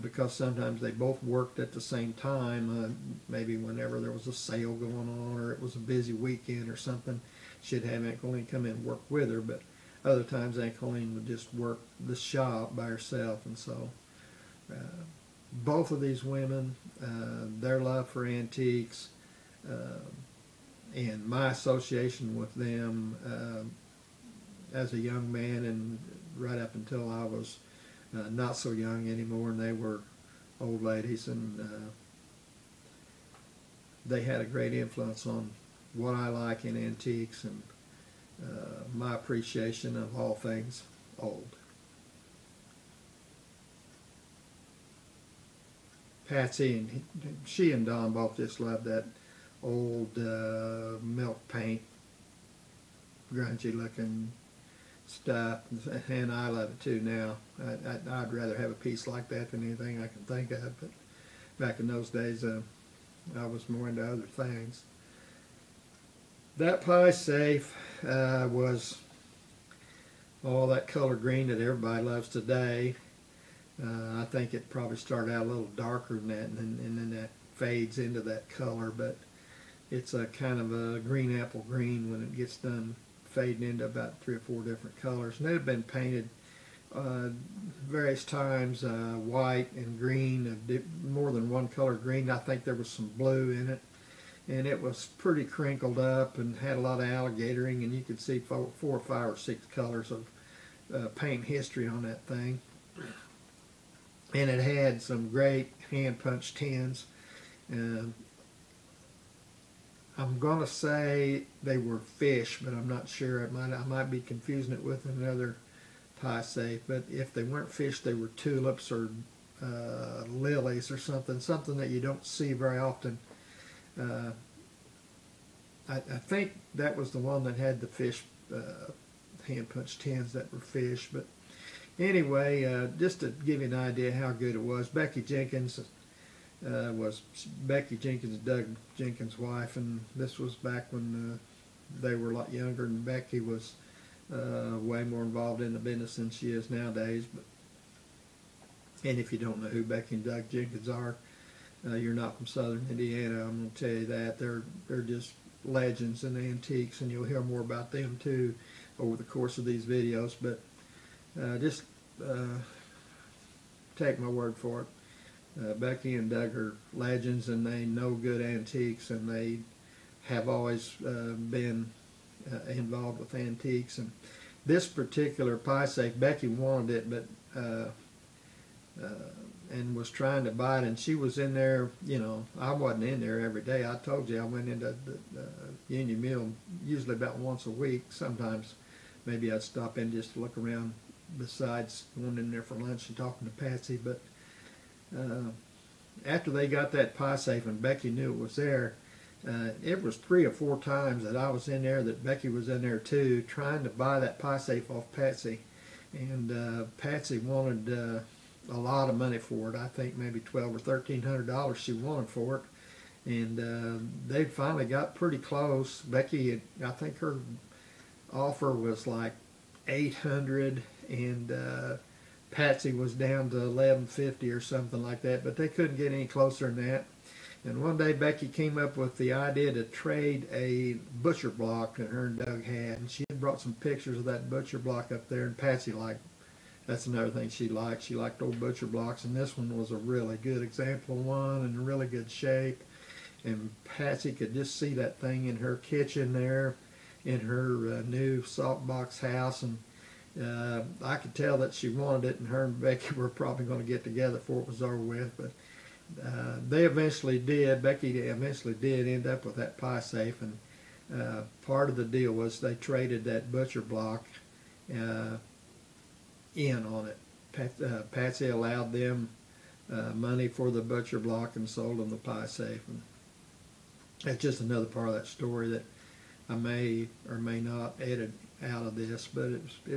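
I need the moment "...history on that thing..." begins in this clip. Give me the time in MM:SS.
01:41.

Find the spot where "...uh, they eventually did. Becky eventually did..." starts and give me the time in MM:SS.
04:16.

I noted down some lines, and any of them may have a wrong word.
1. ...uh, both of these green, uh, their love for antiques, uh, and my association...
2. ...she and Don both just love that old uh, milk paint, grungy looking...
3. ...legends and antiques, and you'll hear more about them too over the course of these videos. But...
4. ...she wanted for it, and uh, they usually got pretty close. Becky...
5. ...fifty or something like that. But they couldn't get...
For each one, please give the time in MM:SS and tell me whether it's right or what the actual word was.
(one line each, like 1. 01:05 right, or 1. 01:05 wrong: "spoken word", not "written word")
1. 00:14 wrong: "women", not "green"
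2. 00:47 right
3. 02:35 right
4. 03:31 wrong: "finally", not "usually"
5. 03:44 right.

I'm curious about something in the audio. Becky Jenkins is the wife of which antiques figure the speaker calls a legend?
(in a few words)
Doug Jenkins.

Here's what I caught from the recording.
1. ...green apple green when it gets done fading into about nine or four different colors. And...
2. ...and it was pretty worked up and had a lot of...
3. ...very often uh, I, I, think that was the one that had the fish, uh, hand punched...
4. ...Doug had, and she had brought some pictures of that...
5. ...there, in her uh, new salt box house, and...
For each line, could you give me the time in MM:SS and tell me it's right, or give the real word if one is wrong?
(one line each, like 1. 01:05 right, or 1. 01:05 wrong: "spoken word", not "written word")
1. 01:20 wrong: "three", not "nine"
2. 01:34 wrong: "crinkled", not "worked"
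3. 02:02 right
4. 03:52 right
5. 04:06 right.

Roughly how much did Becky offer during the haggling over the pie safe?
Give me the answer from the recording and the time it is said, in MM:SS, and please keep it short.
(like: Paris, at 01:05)
$800, at 03:39.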